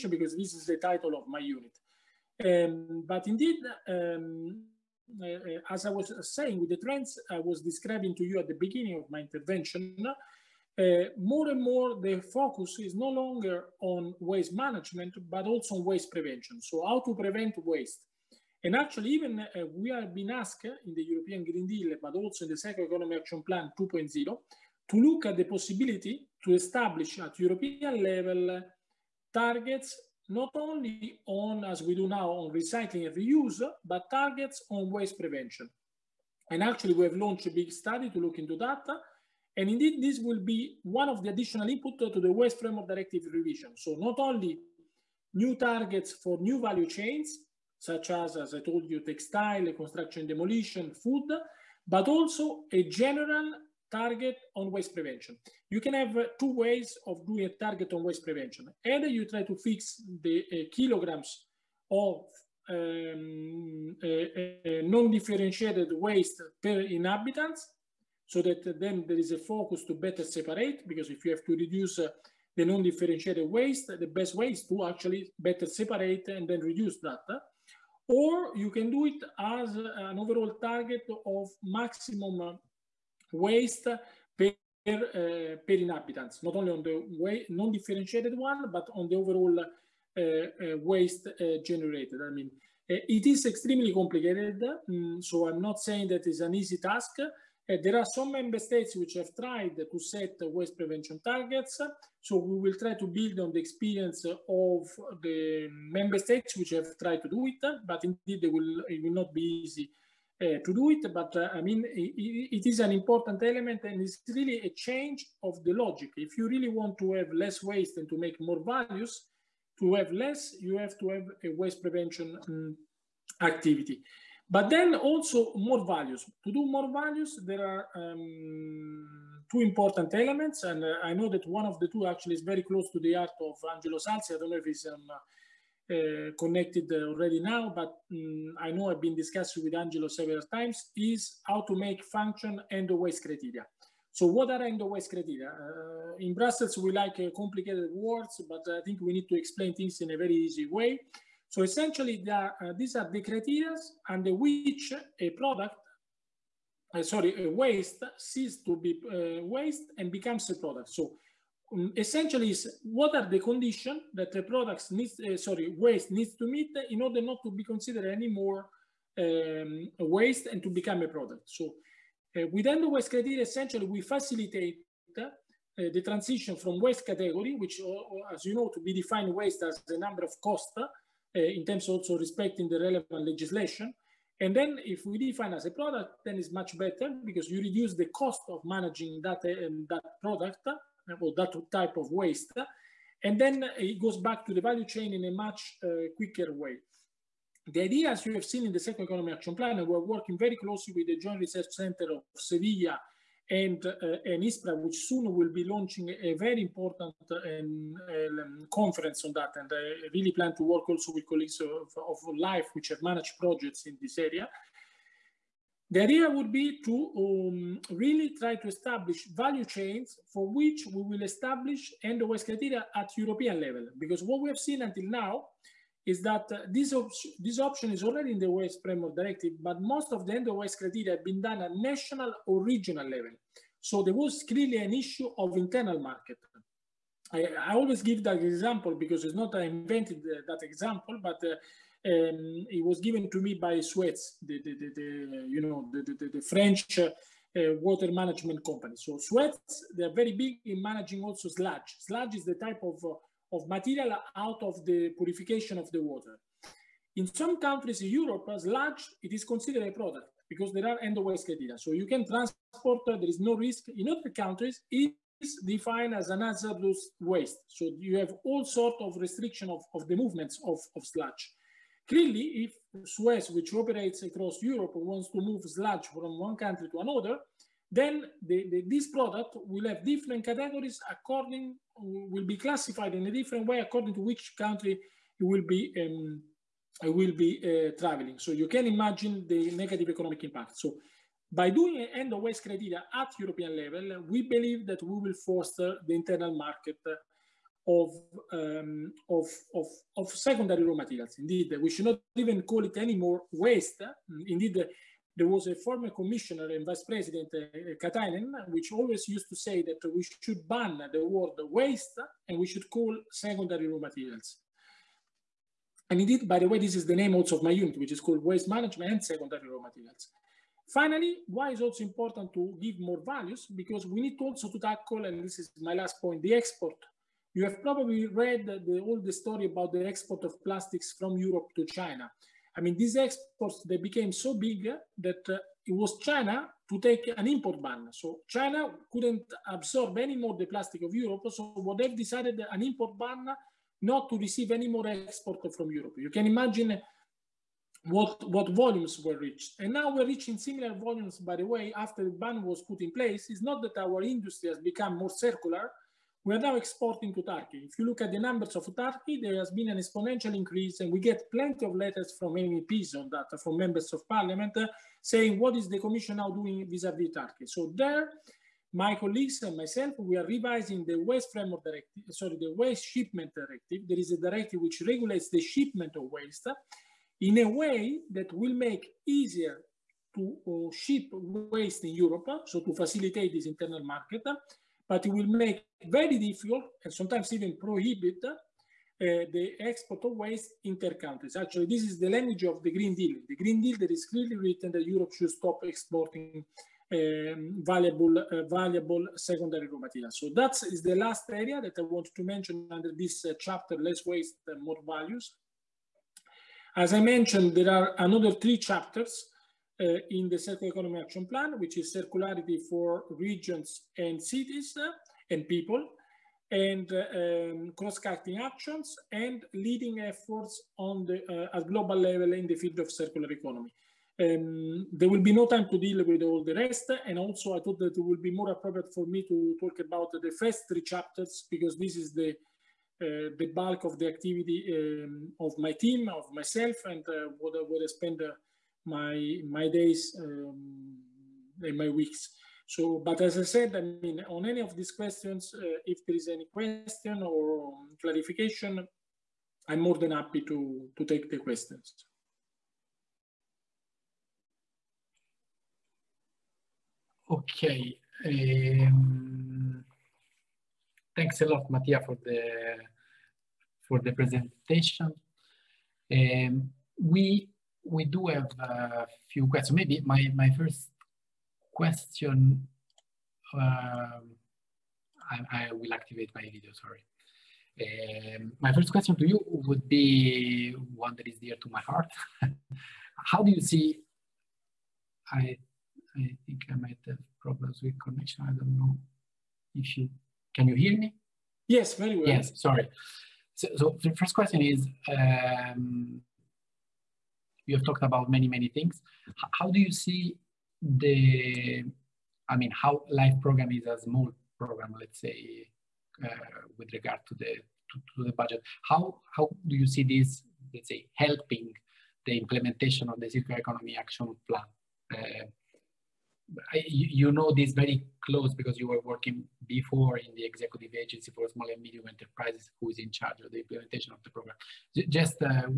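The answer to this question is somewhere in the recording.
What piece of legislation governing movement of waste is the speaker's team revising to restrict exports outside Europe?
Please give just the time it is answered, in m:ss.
6:12.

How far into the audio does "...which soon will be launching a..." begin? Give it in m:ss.
3:24.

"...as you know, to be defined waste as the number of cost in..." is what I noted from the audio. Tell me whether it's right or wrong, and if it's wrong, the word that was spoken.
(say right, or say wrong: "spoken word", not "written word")
right.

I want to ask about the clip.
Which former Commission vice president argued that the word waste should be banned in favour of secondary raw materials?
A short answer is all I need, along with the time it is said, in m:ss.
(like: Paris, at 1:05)
Katainen, at 5:08.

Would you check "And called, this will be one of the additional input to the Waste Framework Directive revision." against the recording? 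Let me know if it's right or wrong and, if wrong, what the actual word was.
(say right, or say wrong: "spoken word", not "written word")
wrong: "indeed", not "called".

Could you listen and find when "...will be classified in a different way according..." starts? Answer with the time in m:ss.
4:41.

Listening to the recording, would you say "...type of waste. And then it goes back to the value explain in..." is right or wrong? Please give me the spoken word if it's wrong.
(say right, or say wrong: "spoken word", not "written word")
wrong: "chain", not "explain".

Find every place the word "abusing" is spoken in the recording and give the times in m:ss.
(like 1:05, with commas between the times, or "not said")
not said.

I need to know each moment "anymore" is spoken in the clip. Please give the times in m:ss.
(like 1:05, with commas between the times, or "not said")
2:48, 5:02.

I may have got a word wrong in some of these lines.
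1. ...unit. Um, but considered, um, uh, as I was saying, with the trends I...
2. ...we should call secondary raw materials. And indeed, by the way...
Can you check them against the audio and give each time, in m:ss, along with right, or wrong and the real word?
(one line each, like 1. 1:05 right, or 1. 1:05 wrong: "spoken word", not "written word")
1. 0:01 wrong: "indeed", not "considered"
2. 5:12 right.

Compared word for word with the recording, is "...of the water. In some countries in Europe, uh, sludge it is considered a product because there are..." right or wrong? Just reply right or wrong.
right.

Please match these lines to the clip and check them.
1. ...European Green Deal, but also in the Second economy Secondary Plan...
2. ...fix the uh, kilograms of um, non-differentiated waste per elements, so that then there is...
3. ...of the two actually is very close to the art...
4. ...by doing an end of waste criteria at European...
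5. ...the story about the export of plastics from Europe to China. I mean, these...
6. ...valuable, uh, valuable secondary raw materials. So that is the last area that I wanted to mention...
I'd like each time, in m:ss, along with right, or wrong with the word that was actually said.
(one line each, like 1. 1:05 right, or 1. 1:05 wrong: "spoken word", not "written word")
1. 0:21 wrong: "Action", not "Secondary"
2. 0:59 wrong: "inhabitants", not "elements"
3. 2:11 right
4. 4:51 right
5. 5:29 right
6. 6:37 right.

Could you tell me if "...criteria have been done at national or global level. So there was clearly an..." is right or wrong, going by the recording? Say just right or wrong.
wrong.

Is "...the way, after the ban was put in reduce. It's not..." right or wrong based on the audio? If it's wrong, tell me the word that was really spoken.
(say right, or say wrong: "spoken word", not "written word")
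wrong: "place", not "reduce".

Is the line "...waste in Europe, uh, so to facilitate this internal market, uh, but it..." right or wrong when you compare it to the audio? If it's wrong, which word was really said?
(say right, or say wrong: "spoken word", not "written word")
right.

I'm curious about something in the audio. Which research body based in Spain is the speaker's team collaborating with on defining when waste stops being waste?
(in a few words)
Joint Research Center of Sevilla.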